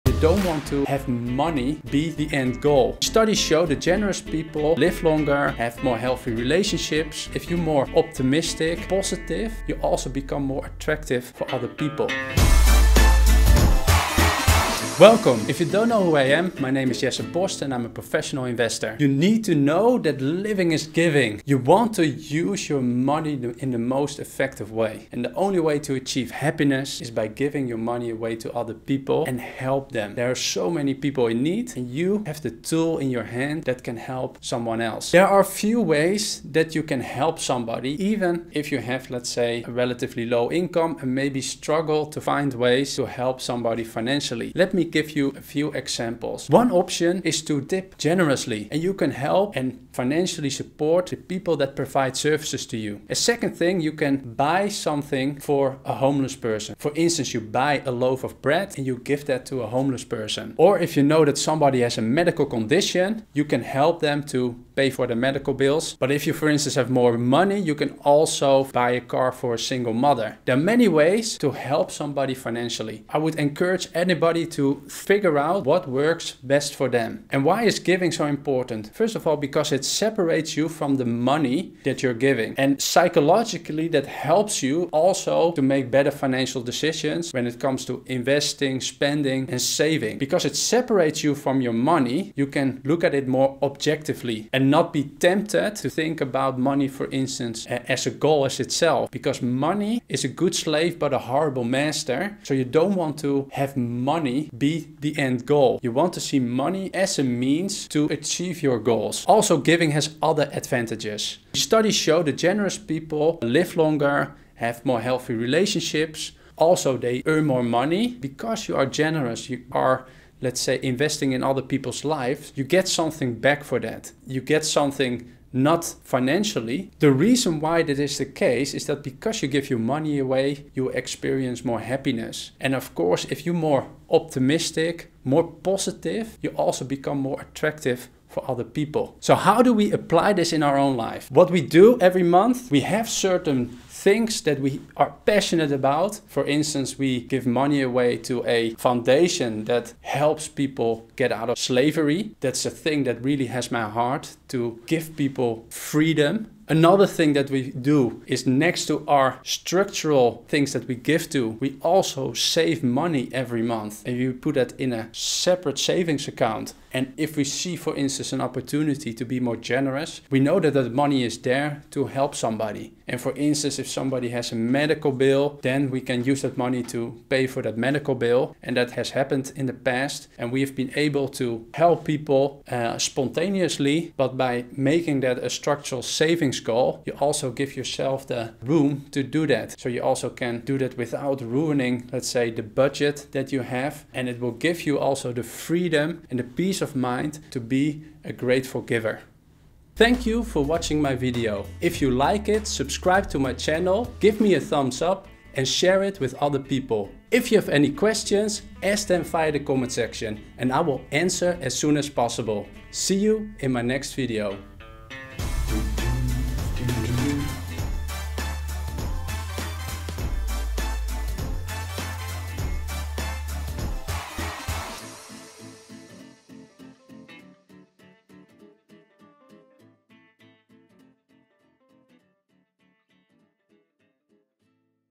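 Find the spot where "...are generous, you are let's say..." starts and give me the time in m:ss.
1:58.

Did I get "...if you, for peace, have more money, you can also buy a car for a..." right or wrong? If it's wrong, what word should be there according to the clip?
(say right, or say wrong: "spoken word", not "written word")
wrong: "instance", not "peace".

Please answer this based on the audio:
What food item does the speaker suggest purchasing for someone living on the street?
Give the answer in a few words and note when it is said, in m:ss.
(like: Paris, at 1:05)
a loaf of bread, at 0:57.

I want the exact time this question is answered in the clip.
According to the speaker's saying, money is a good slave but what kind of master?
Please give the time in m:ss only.
1:41.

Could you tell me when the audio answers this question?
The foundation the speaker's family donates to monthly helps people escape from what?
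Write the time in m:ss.
2:31.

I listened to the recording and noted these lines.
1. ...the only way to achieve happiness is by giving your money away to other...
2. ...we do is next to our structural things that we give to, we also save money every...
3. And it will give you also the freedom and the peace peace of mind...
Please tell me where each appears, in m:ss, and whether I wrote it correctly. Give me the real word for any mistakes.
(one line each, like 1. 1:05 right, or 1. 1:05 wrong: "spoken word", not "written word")
1. 0:25 right
2. 2:37 right
3. 3:14 right.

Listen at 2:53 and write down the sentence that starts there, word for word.
And for instance, if somebody has a medical bill, then we can use that money to pay for that medical bill.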